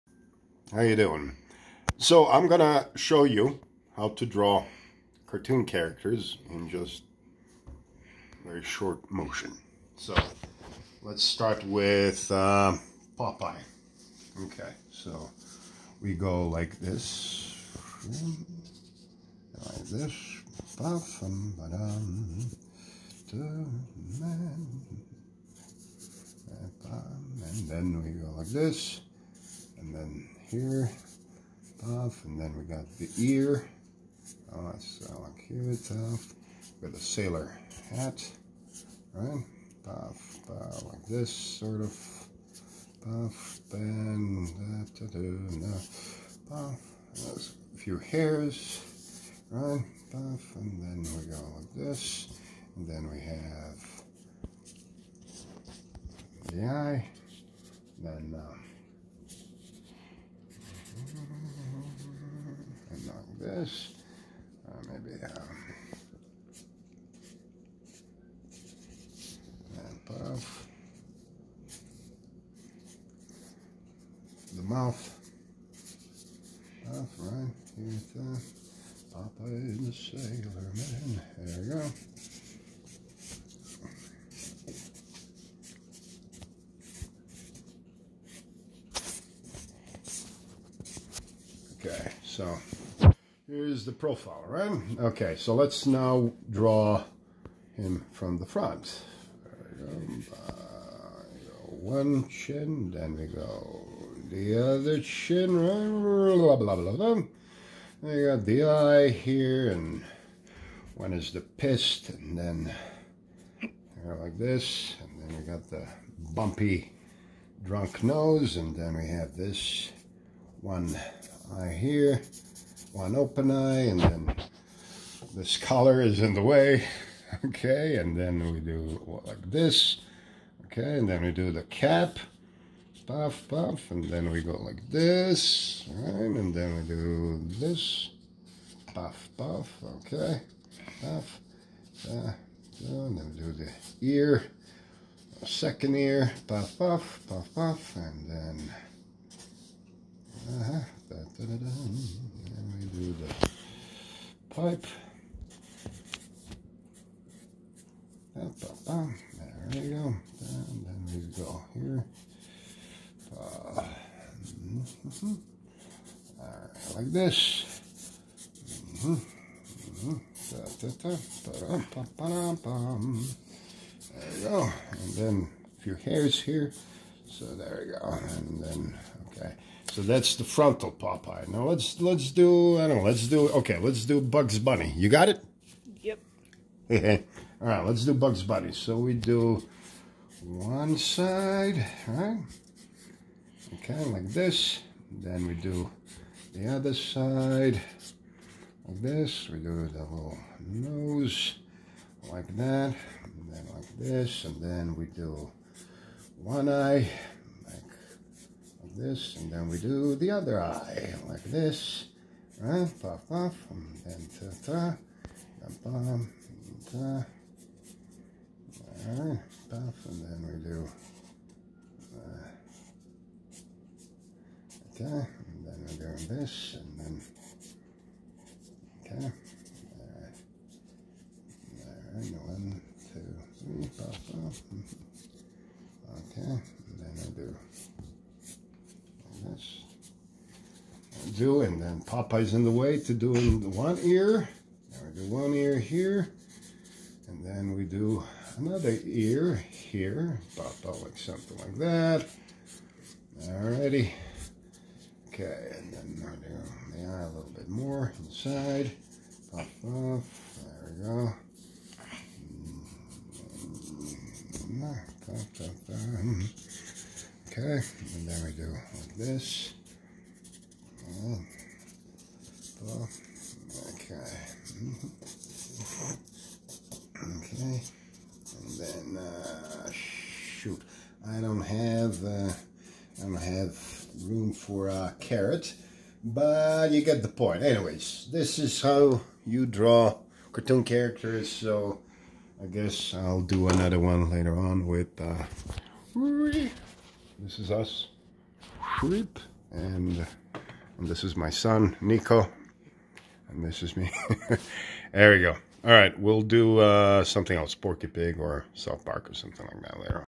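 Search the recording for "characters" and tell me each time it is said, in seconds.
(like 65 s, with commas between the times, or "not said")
5 s, 290 s.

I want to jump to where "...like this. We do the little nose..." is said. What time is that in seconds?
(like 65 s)
198 s.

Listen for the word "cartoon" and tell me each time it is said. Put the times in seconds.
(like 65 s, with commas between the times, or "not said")
5 s, 290 s.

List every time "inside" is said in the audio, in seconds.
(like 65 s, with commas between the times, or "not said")
258 s.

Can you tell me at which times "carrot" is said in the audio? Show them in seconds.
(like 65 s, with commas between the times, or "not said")
285 s.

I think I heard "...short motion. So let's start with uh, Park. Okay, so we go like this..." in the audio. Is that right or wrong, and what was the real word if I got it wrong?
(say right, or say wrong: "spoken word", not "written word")
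wrong: "Popeye", not "Park".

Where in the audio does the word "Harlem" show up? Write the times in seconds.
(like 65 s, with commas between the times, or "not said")
not said.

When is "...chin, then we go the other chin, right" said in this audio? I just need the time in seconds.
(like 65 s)
102 s.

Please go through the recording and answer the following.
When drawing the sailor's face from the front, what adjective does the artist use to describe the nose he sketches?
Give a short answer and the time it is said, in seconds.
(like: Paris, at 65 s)
bumpy drunk, at 116 s.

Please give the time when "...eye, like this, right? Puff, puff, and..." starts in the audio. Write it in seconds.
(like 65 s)
210 s.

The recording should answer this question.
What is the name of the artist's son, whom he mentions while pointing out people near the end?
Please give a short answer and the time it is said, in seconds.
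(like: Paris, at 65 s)
Nico, at 301 s.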